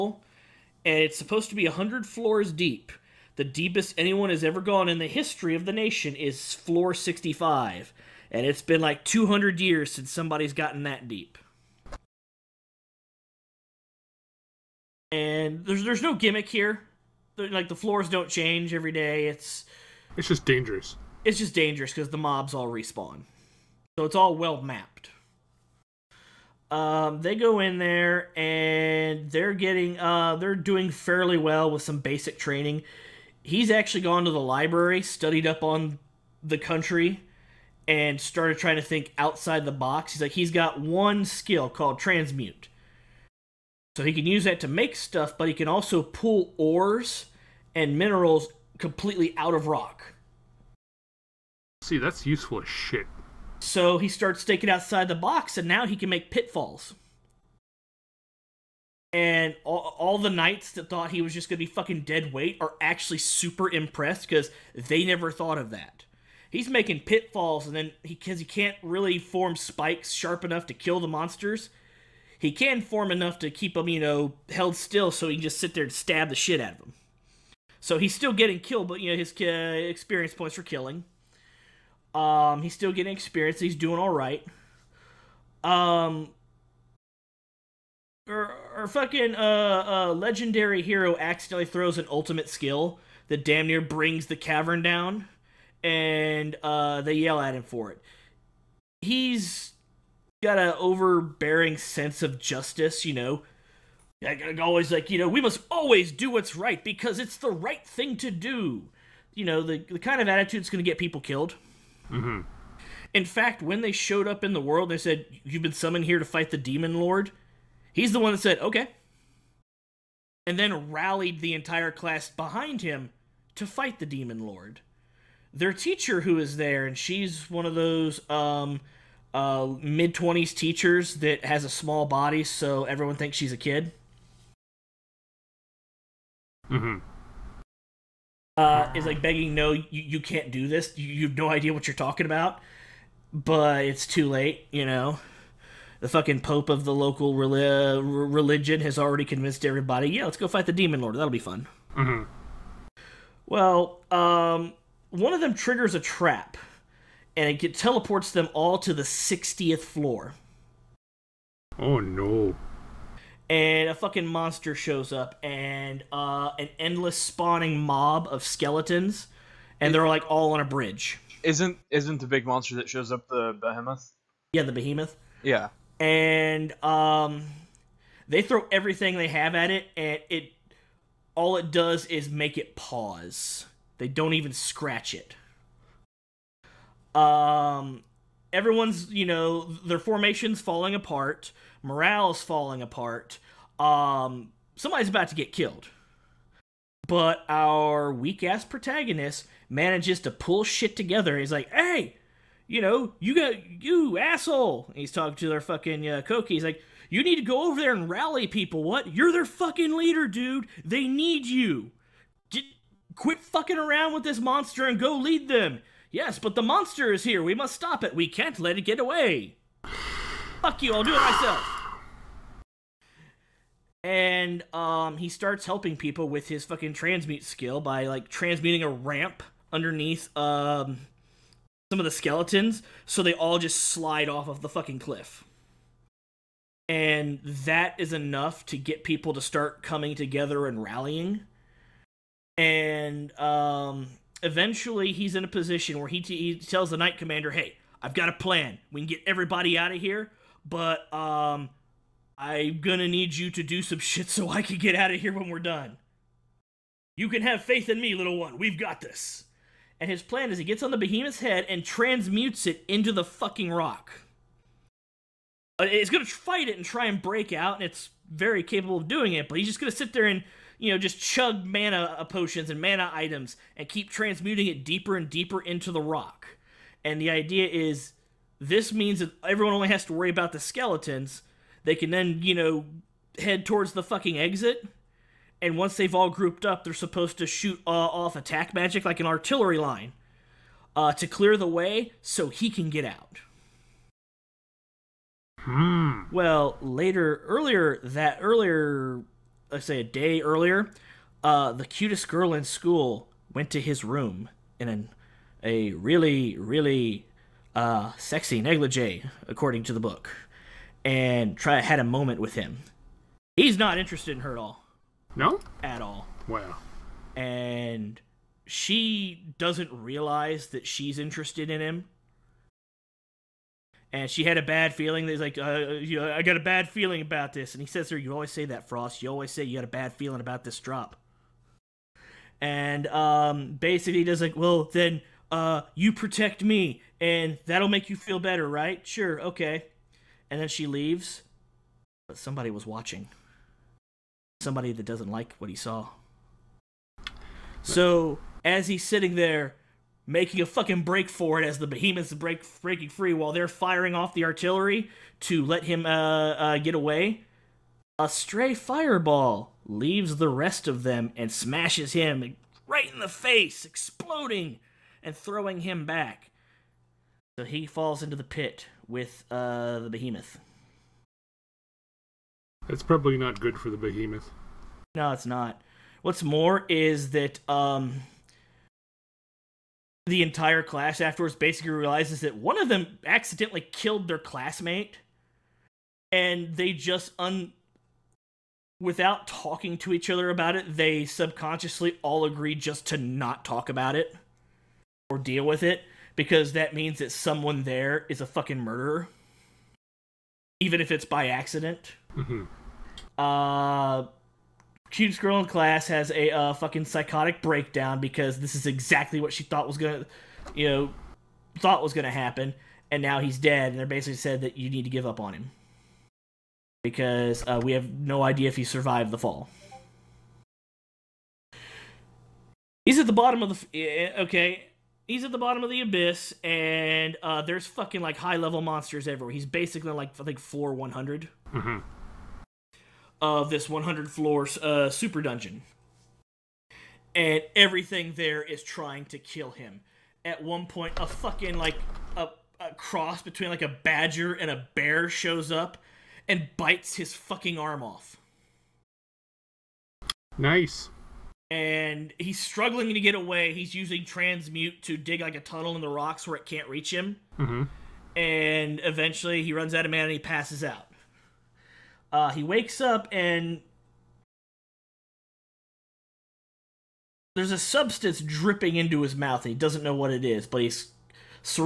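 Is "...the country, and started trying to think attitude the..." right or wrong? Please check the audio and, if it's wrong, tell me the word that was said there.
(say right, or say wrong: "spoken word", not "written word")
wrong: "outside", not "attitude".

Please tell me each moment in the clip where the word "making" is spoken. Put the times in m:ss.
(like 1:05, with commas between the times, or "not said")
1:06, 5:50.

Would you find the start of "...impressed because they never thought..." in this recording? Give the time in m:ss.
1:03.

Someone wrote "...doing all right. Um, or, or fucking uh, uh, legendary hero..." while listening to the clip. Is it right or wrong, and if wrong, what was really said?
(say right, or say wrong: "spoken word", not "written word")
right.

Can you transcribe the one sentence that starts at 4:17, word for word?
You can have faith in me, little one.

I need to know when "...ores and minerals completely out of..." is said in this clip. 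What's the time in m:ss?
0:46.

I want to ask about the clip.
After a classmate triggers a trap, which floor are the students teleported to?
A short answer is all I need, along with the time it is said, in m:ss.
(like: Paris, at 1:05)
60th floor, at 2:39.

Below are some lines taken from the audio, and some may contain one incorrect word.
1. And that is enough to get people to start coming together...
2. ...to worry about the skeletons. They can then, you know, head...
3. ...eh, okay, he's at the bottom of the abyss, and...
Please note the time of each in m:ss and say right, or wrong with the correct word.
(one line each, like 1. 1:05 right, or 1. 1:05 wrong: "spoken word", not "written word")
1. 3:56 right
2. 4:40 right
3. 7:04 right.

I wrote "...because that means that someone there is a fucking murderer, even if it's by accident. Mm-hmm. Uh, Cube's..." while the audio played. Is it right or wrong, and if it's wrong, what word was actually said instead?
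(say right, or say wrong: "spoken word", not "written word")
right.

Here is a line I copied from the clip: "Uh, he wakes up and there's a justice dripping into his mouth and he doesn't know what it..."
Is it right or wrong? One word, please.
wrong.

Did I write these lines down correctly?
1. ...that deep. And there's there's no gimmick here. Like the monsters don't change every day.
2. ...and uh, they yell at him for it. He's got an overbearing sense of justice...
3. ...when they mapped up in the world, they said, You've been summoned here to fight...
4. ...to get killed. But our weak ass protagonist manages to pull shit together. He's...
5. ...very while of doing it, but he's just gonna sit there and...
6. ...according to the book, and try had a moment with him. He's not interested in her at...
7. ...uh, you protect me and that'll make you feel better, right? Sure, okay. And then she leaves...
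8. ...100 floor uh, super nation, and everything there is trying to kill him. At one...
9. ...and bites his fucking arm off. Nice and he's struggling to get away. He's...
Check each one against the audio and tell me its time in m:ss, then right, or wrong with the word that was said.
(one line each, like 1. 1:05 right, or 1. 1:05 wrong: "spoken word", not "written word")
1. 0:10 wrong: "floors", not "monsters"
2. 1:35 right
3. 1:53 wrong: "showed", not "mapped"
4. 3:15 right
5. 4:28 wrong: "capable", not "while"
6. 5:09 right
7. 5:35 right
8. 7:13 wrong: "dungeon", not "nation"
9. 7:26 right.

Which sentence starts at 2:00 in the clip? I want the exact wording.
And then rallied the entire class behind him to fight the demon lord.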